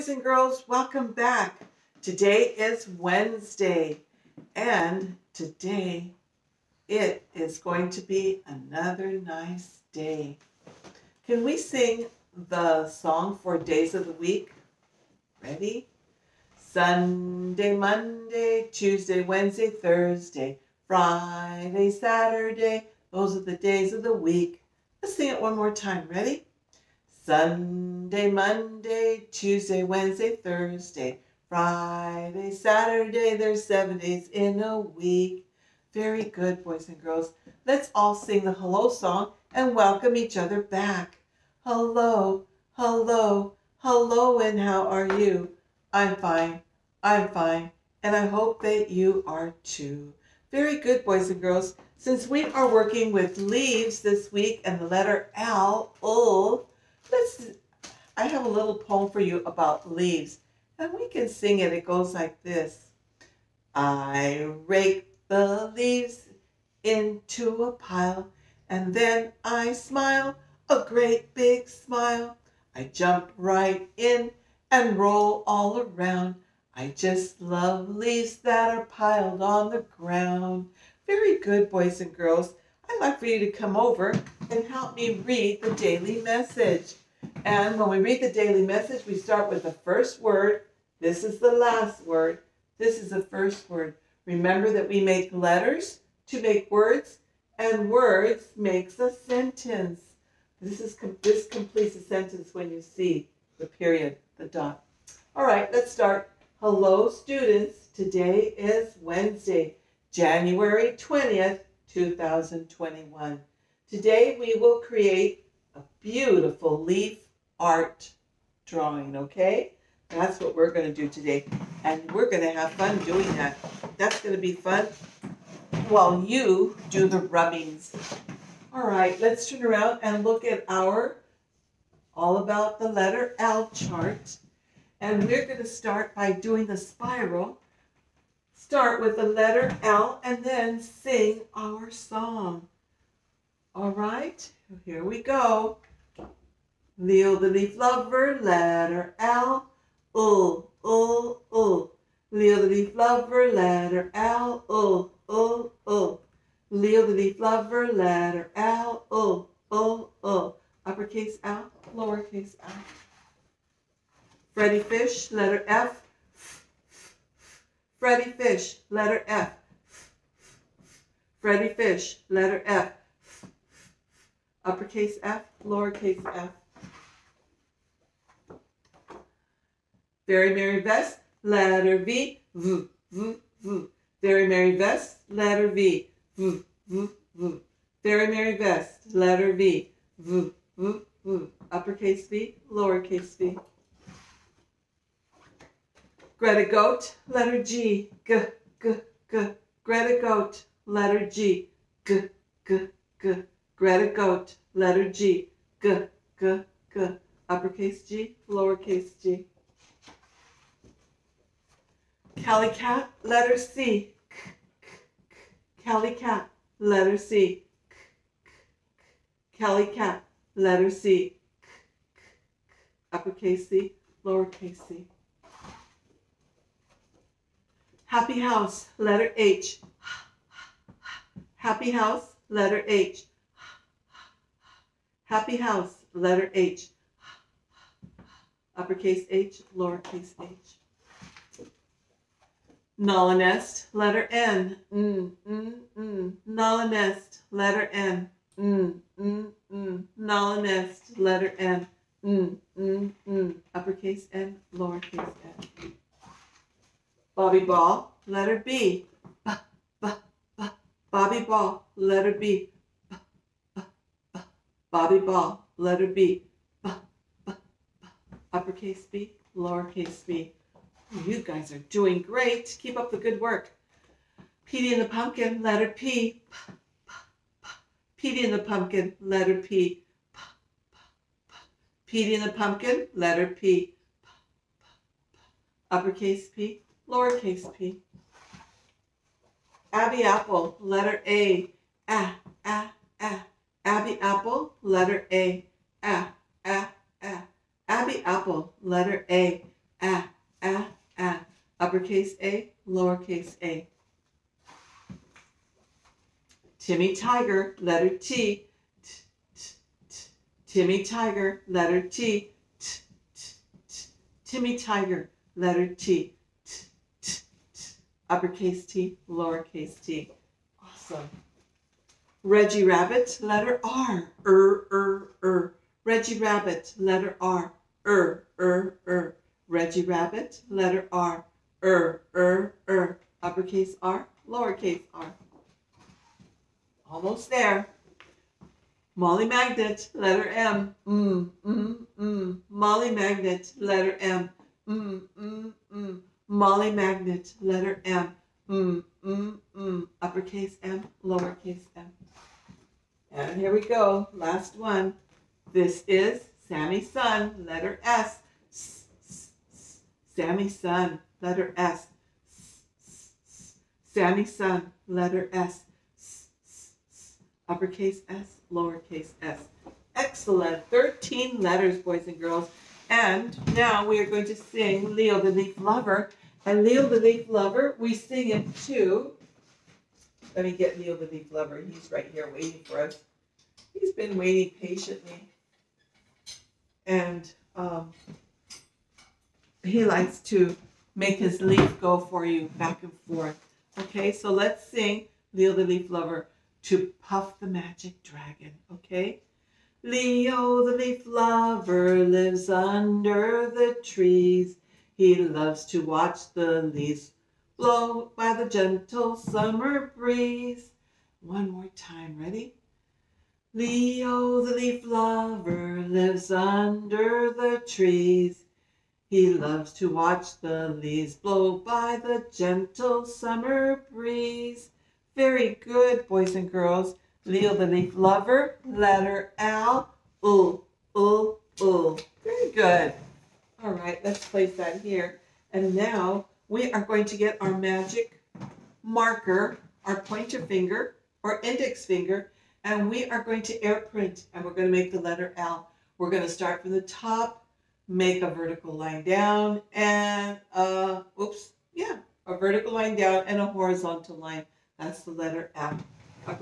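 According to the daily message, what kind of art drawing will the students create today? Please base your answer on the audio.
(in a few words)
leaf art drawing.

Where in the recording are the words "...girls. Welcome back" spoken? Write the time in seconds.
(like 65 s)
0 s.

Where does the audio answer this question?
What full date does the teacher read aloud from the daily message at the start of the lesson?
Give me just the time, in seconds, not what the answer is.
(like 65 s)
110 s.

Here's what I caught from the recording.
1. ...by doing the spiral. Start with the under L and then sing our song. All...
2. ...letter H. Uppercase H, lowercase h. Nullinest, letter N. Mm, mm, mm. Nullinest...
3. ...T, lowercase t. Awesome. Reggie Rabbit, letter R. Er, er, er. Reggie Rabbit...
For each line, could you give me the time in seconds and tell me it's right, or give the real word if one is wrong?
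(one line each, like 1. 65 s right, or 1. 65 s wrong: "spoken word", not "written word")
1. 136 s wrong: "letter", not "under"
2. 236 s right
3. 318 s right.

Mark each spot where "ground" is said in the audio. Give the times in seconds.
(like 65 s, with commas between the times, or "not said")
79 s.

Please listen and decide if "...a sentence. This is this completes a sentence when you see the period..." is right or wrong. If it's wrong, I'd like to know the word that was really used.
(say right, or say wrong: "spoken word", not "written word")
right.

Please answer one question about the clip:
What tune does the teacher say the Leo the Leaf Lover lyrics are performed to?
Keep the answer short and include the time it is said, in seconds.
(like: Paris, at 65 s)
Puff the Magic Dragon, at 397 s.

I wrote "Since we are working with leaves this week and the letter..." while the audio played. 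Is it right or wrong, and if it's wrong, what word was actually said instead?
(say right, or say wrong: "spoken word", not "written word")
right.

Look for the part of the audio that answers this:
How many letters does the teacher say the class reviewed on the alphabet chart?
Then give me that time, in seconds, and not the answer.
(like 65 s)
370 s.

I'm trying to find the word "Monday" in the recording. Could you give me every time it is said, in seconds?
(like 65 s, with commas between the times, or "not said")
17 s, 28 s.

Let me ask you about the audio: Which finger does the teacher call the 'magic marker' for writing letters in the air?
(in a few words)
pointer finger.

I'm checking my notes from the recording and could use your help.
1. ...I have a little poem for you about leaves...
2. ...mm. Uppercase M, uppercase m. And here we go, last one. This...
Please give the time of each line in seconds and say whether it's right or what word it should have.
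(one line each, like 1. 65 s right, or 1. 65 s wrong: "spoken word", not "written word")
1. 58 s right
2. 349 s wrong: "lowercase", not "uppercase".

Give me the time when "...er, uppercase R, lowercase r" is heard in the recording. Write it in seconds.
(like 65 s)
332 s.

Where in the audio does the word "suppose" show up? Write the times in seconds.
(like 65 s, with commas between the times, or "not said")
not said.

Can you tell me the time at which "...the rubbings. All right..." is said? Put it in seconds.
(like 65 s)
127 s.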